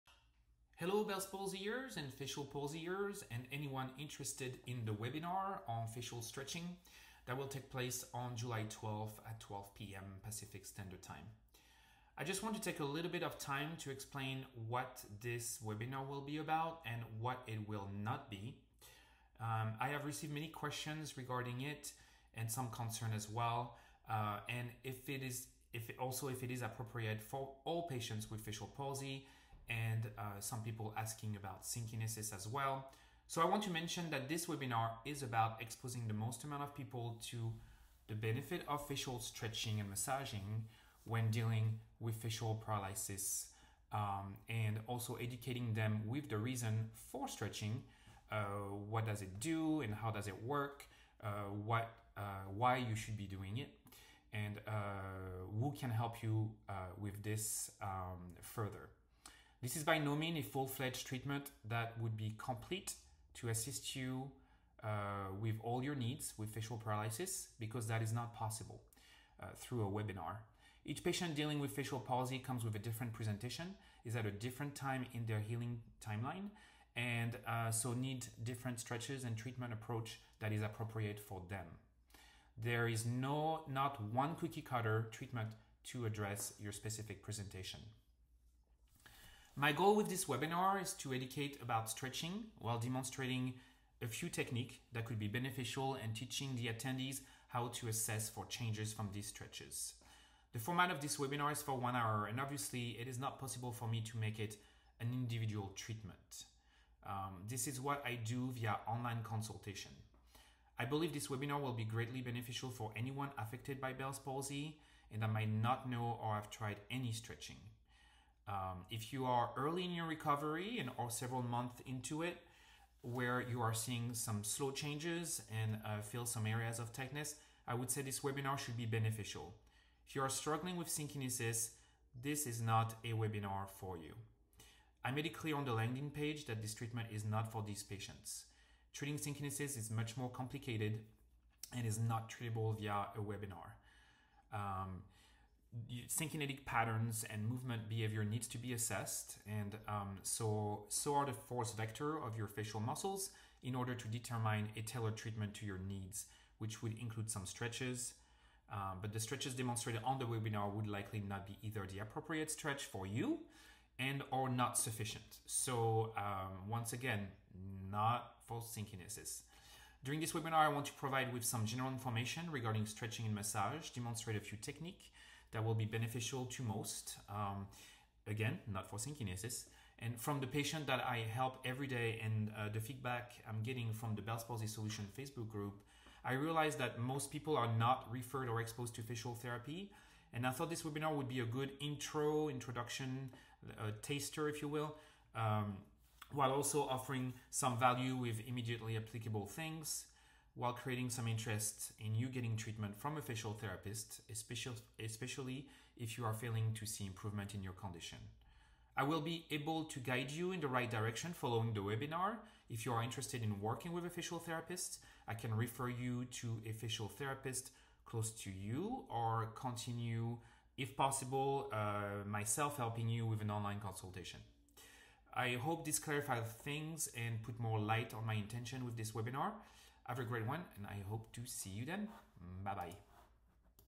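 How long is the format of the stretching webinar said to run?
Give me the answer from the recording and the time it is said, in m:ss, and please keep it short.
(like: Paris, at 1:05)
one hour, at 1:41.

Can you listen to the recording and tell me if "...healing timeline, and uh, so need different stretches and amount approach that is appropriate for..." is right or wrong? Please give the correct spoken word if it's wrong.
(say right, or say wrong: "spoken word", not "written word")
wrong: "treatment", not "amount".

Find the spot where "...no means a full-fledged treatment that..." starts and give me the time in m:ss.
0:59.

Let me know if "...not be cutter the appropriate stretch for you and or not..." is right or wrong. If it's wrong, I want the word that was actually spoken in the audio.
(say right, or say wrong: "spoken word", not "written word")
wrong: "either", not "cutter".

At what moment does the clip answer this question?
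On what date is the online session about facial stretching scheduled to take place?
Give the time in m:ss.
0:08.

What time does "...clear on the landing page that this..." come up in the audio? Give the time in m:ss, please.
2:15.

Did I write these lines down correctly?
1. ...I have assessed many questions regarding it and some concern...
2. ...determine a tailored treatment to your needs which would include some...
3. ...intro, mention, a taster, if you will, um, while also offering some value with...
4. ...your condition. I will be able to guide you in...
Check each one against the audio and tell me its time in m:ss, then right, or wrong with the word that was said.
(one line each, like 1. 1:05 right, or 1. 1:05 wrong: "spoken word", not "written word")
1. 0:19 wrong: "received", not "assessed"
2. 2:34 right
3. 3:11 wrong: "introduction", not "mention"
4. 3:27 right.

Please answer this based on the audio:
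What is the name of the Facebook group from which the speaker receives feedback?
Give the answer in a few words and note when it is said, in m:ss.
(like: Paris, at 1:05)
Bell's Palsy Solution, at 3:04.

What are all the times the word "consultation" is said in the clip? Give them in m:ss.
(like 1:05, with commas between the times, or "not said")
1:49, 3:43.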